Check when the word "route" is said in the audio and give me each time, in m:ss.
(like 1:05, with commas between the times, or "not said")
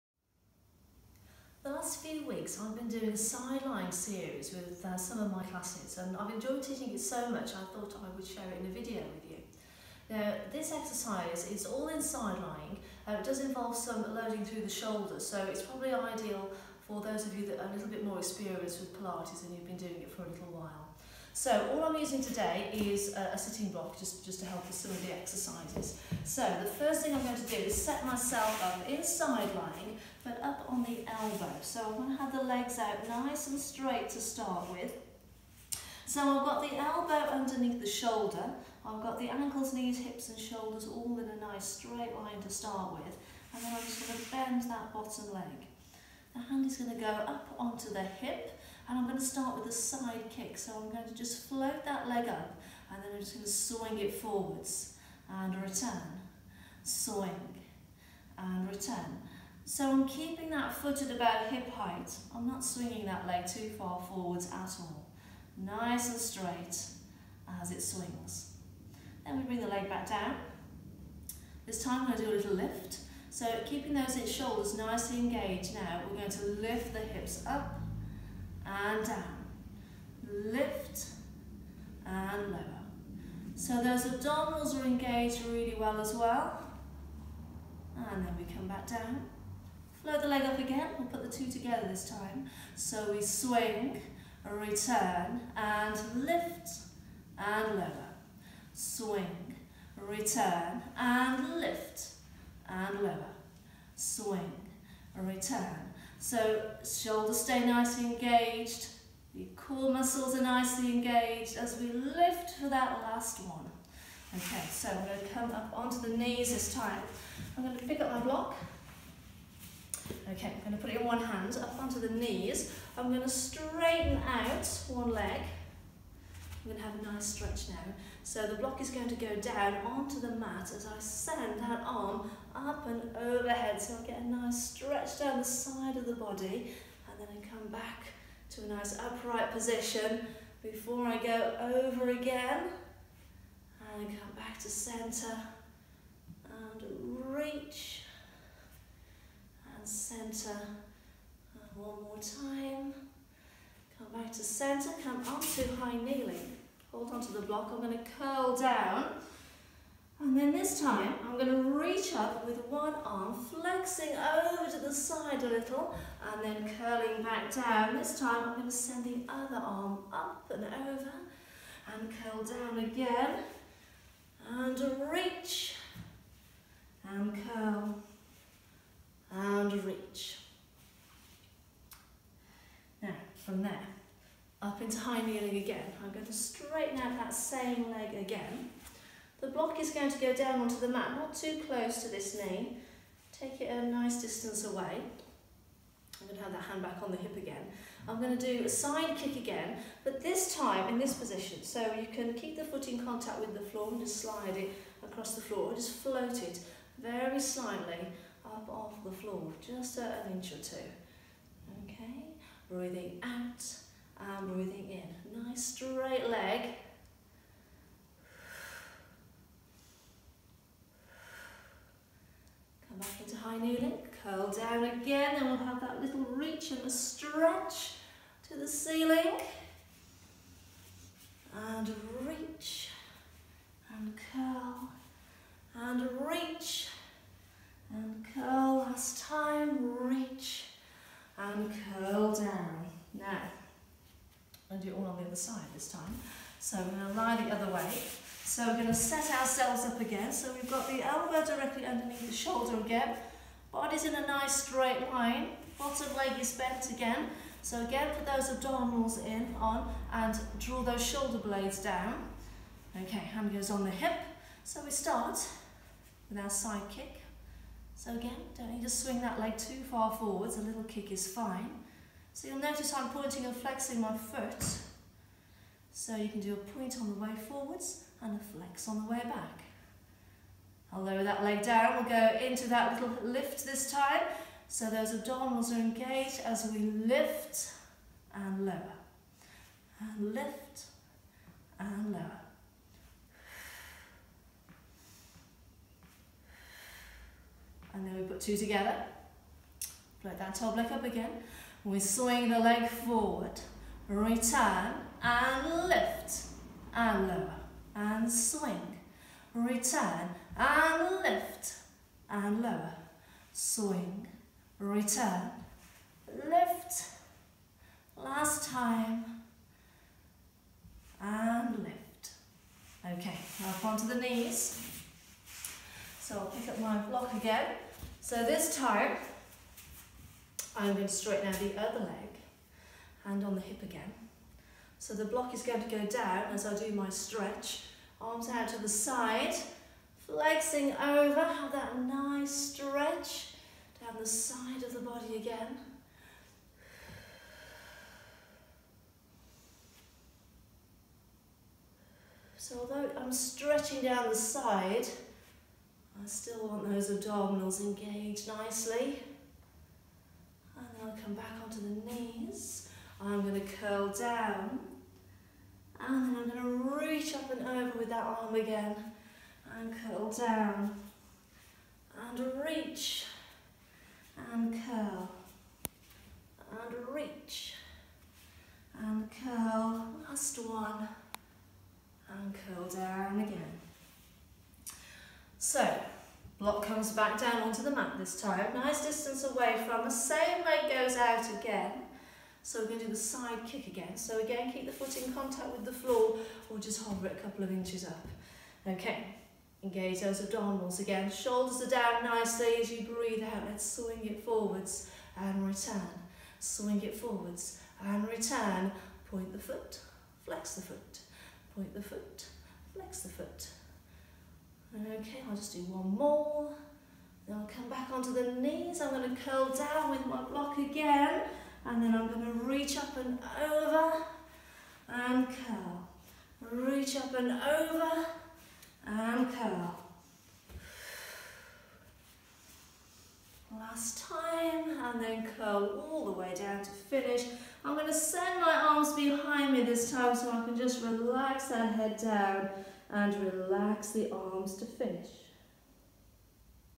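not said.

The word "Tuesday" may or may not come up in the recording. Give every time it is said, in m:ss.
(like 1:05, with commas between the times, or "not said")
not said.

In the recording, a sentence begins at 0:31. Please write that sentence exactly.
So I am going to have the legs out nice and straight to start with.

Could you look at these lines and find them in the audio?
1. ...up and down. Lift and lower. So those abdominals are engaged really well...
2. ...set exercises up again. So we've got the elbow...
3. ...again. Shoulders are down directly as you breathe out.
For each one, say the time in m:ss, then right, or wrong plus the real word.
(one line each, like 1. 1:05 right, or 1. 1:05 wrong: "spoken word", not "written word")
1. 1:17 right
2. 4:08 wrong: "ourselves", not "exercises"
3. 6:40 wrong: "nicely", not "directly".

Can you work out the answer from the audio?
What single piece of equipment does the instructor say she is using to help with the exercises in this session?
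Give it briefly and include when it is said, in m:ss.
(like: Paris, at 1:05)
sitting block, at 0:23.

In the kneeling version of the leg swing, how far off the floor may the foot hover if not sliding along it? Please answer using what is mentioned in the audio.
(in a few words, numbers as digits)
an inch or two.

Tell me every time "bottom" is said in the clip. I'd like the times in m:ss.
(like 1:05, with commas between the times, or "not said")
0:44, 4:15.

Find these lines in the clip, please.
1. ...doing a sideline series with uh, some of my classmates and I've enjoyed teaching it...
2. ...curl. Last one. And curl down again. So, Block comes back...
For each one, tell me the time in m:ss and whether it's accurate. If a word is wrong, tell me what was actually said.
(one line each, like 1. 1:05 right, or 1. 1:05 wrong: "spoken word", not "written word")
1. 0:02 right
2. 6:19 right.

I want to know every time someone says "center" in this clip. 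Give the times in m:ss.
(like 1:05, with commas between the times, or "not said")
2:24, 2:29, 2:34.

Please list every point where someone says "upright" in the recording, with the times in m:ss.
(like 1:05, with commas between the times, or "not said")
2:18.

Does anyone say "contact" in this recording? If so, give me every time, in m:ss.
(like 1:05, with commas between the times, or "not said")
3:23, 6:35.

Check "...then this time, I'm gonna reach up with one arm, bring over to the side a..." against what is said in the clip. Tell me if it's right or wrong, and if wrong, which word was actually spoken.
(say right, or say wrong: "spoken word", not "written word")
wrong: "flexing", not "bring".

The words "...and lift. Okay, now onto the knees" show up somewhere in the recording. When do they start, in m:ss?
5:21.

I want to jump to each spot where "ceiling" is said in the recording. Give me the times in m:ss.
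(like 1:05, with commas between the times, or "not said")
3:48.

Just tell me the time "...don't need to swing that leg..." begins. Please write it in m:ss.
4:28.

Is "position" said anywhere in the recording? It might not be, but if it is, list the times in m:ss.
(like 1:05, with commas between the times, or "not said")
2:19, 3:21.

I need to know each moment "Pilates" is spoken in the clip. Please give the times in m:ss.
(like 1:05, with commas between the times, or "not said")
0:18.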